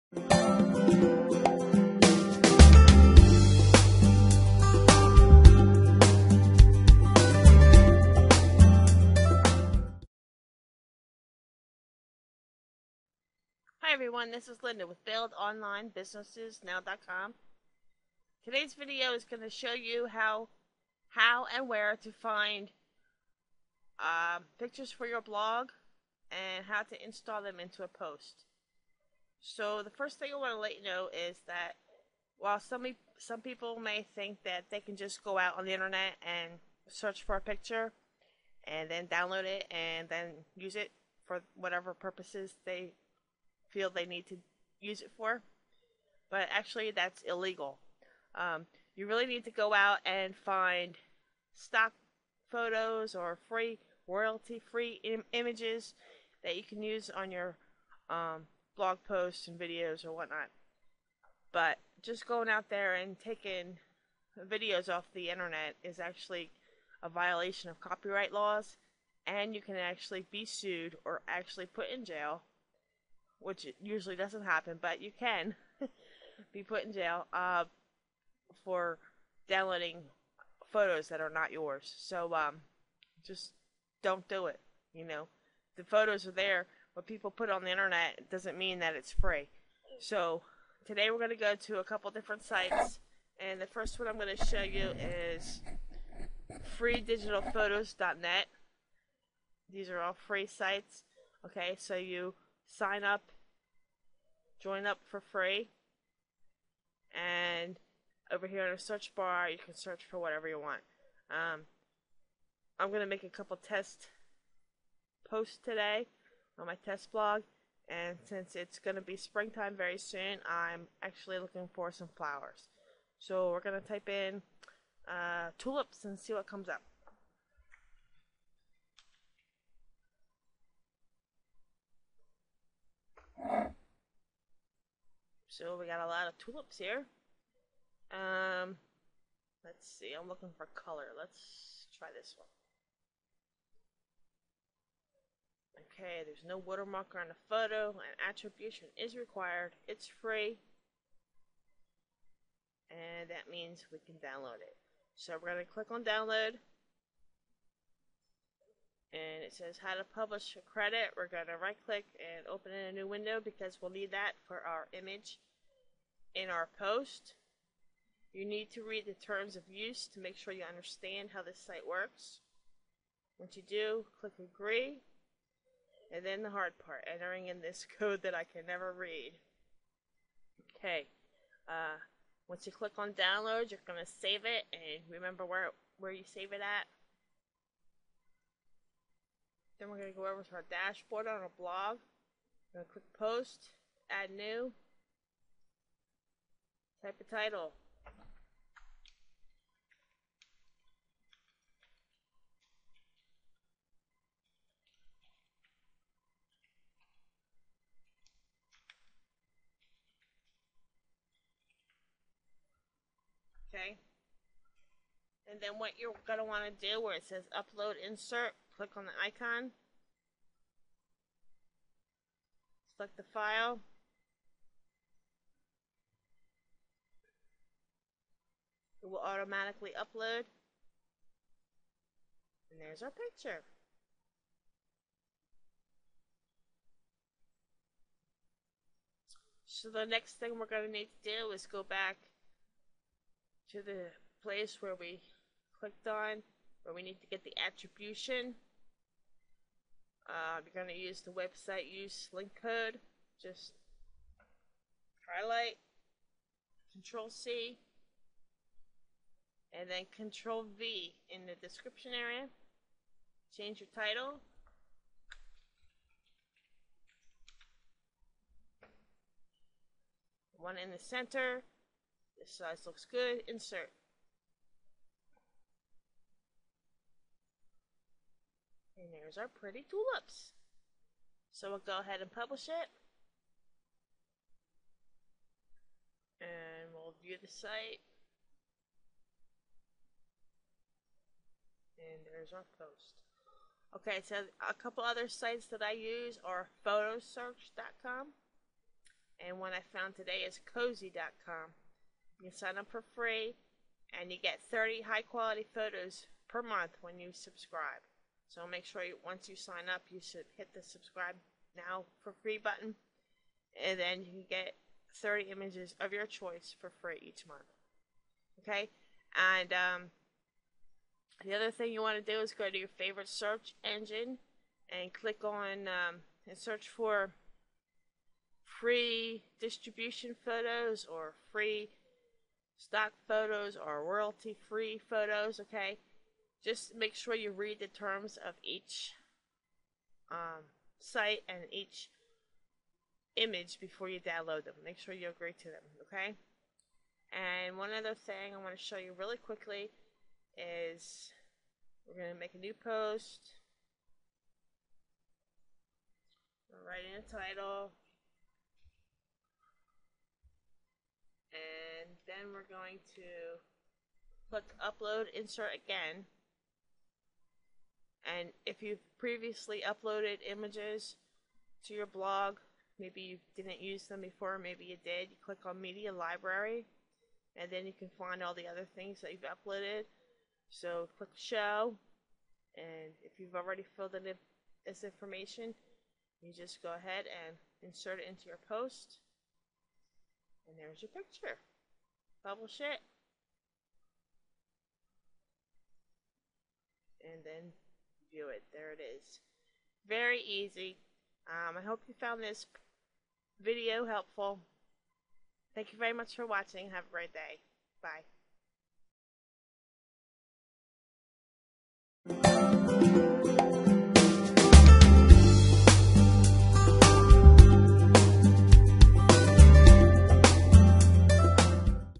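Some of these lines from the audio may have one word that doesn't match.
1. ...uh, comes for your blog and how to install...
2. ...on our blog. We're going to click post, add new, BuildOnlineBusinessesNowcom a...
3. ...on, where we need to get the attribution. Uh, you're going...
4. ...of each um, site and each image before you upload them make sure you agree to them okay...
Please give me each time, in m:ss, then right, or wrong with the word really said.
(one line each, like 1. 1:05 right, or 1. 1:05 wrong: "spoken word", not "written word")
1. 0:23 wrong: "pictures", not "comes"
2. 3:11 wrong: "Type", not "BuildOnlineBusinessesNowcom"
3. 4:06 right
4. 5:38 wrong: "download", not "upload".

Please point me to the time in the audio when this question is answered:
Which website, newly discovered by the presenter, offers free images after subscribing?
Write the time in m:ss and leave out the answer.
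5:00.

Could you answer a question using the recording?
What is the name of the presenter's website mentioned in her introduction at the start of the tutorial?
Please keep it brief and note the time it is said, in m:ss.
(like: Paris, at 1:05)
BuildOnlineBusinessesNow.com, at 0:15.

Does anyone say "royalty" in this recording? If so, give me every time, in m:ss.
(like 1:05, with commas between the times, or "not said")
0:54, 5:34.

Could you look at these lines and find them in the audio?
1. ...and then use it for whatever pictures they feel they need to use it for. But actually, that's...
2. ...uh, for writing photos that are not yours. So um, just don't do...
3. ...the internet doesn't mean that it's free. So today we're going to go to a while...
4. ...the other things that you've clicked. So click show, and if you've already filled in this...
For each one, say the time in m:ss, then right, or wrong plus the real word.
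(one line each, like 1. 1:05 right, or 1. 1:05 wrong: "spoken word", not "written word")
1. 0:39 wrong: "purposes", not "pictures"
2. 1:17 wrong: "downloading", not "writing"
3. 1:27 wrong: "couple", not "while"
4. 6:18 wrong: "uploaded", not "clicked".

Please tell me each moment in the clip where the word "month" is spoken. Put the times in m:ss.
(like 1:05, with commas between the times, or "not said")
5:06, 5:17.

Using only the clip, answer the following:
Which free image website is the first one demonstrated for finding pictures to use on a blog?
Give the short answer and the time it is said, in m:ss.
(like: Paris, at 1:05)
freedigitalphotos.net, at 1:36.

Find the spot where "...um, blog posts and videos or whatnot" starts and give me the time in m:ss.
0:58.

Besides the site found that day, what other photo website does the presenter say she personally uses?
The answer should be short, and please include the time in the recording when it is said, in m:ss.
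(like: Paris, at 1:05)
fotosearch.com, at 4:56.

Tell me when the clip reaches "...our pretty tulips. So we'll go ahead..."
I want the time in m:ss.
4:39.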